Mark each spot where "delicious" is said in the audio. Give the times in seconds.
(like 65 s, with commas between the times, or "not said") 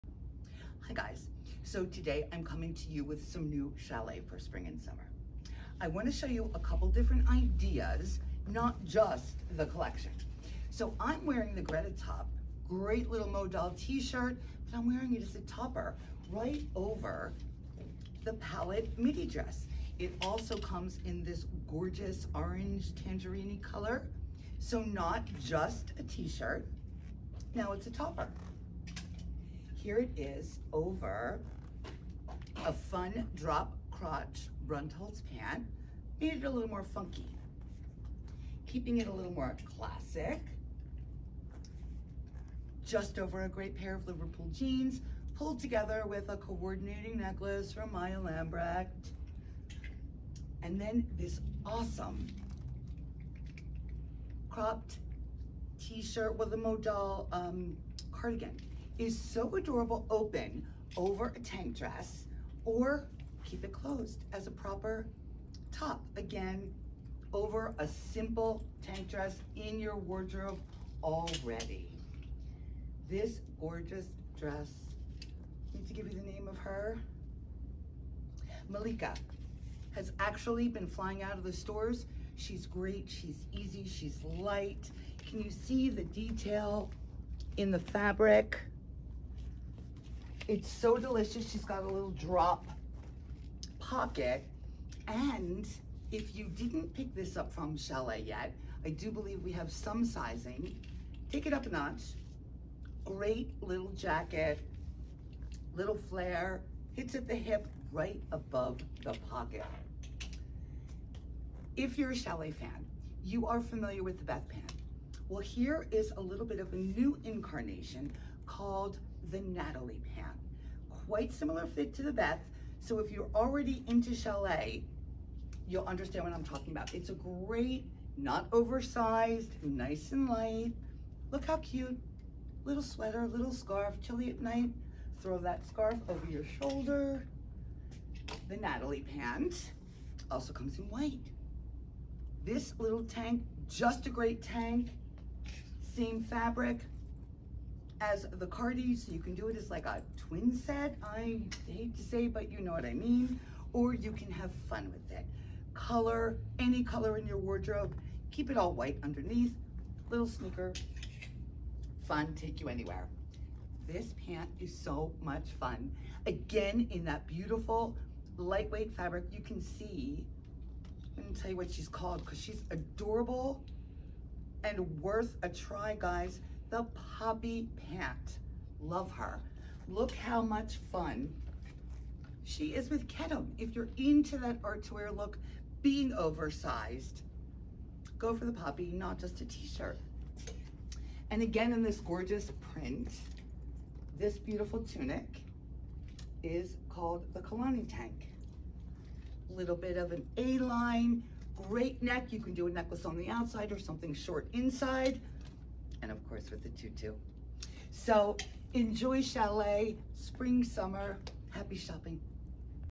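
90 s.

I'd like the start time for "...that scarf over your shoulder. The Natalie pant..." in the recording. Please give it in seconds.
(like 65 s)
135 s.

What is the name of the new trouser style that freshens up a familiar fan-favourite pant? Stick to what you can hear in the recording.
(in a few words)
Natalie Pant.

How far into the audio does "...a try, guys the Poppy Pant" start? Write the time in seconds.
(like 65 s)
175 s.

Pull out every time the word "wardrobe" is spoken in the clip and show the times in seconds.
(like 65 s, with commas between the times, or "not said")
69 s, 157 s.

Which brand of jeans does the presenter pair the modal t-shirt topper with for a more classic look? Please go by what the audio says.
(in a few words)
Liverpool.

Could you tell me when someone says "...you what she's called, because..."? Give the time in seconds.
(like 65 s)
171 s.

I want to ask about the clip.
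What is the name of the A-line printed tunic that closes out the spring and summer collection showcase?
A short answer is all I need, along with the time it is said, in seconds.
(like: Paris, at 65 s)
Kalani Tank, at 197 s.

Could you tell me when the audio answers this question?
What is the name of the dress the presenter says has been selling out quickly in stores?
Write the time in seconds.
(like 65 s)
78 s.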